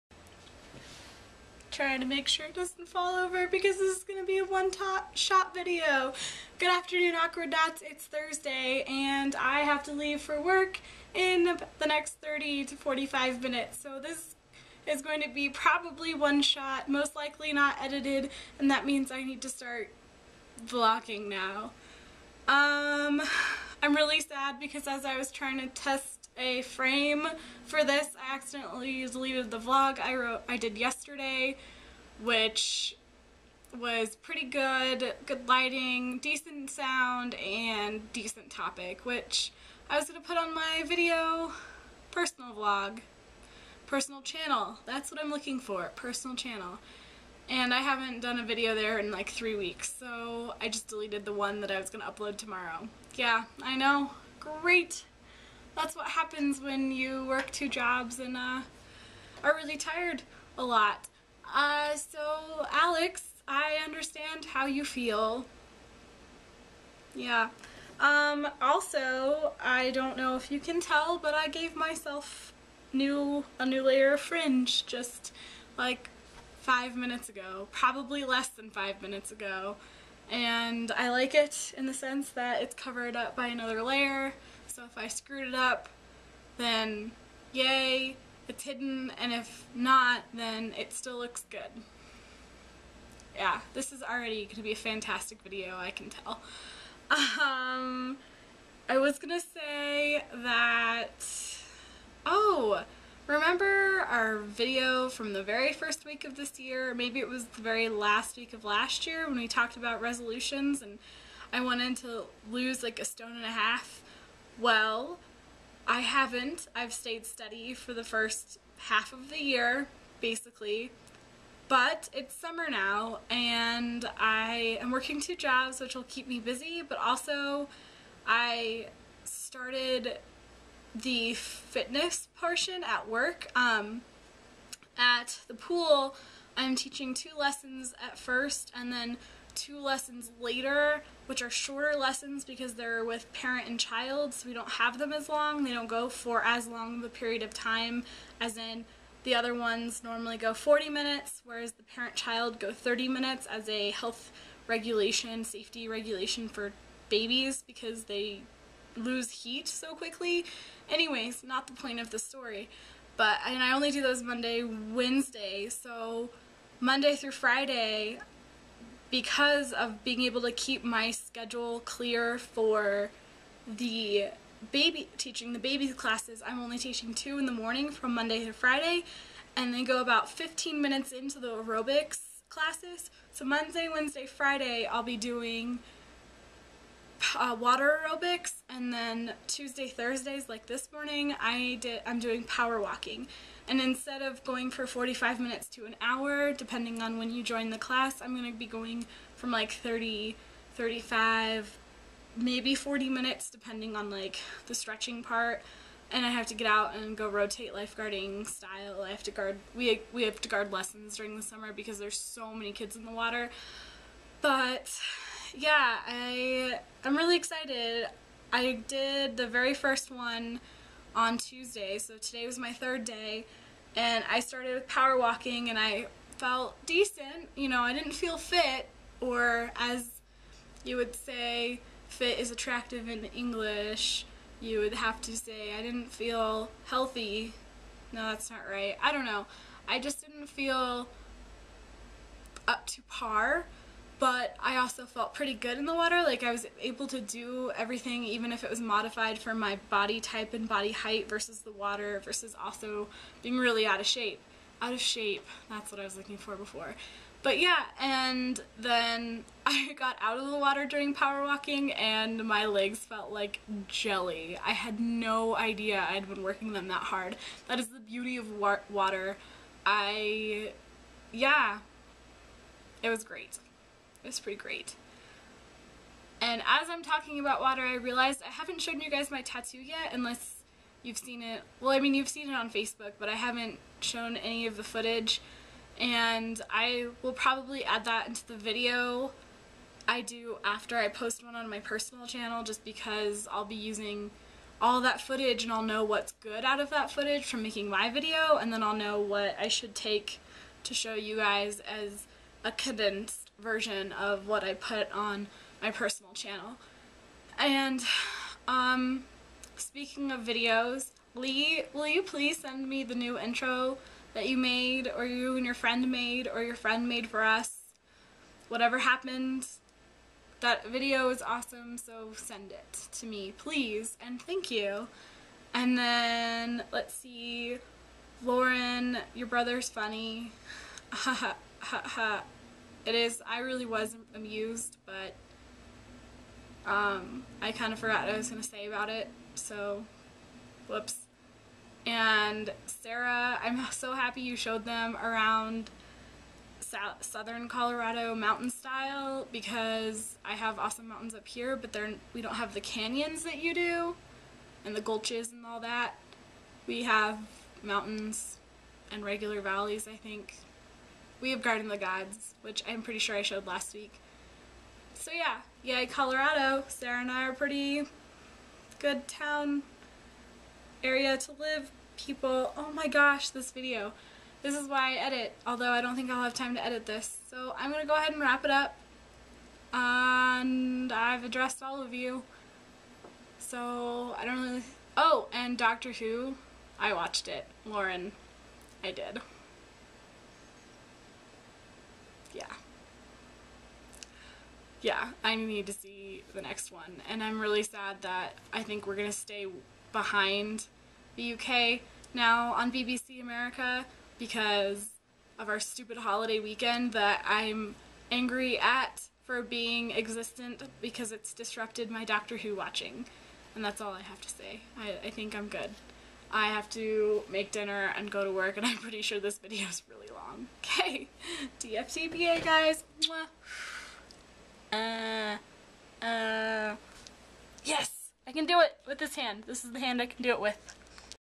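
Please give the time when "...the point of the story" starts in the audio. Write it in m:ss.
2:41.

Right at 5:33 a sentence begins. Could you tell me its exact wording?
I really was amused, but um, I kind of forgot what I was going to say about it, so whoops.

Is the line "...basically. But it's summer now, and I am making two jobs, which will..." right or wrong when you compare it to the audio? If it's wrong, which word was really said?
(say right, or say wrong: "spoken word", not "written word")
wrong: "working", not "making".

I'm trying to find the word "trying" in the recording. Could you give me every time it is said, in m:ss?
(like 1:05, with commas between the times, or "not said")
0:01, 0:25.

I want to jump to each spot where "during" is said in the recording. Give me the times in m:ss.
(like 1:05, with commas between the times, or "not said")
3:31, 4:20.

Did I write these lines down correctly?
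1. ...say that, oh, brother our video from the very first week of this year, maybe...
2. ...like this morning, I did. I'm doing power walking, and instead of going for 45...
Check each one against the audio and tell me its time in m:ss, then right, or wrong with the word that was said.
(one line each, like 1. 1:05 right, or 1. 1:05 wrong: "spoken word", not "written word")
1. 1:39 wrong: "remember", not "brother"
2. 3:10 right.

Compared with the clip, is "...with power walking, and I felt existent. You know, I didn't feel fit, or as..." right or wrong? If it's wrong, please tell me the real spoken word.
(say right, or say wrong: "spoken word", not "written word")
wrong: "decent", not "existent".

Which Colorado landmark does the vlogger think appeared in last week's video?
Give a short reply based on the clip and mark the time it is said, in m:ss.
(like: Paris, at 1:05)
Garden of the Gods, at 6:01.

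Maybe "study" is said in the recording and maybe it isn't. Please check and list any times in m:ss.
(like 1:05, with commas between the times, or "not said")
not said.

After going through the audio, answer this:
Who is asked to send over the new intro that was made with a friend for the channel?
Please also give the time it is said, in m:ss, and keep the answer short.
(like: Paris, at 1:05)
Lee, at 5:11.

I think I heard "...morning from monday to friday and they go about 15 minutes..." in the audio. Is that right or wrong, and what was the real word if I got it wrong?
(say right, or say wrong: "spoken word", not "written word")
right.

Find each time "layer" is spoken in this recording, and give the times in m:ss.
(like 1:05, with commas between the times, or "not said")
1:13, 1:23.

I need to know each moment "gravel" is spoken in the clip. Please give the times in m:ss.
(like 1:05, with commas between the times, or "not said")
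not said.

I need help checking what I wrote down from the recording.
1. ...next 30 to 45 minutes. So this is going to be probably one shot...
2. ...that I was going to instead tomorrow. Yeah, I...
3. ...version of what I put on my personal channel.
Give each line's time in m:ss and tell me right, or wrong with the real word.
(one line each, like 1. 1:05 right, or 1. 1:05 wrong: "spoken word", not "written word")
1. 0:11 right
2. 0:51 wrong: "upload", not "instead"
3. 5:03 right.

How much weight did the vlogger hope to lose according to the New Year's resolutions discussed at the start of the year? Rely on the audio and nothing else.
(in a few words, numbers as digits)
a stone and a half.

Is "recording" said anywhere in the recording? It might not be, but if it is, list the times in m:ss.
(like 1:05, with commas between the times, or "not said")
not said.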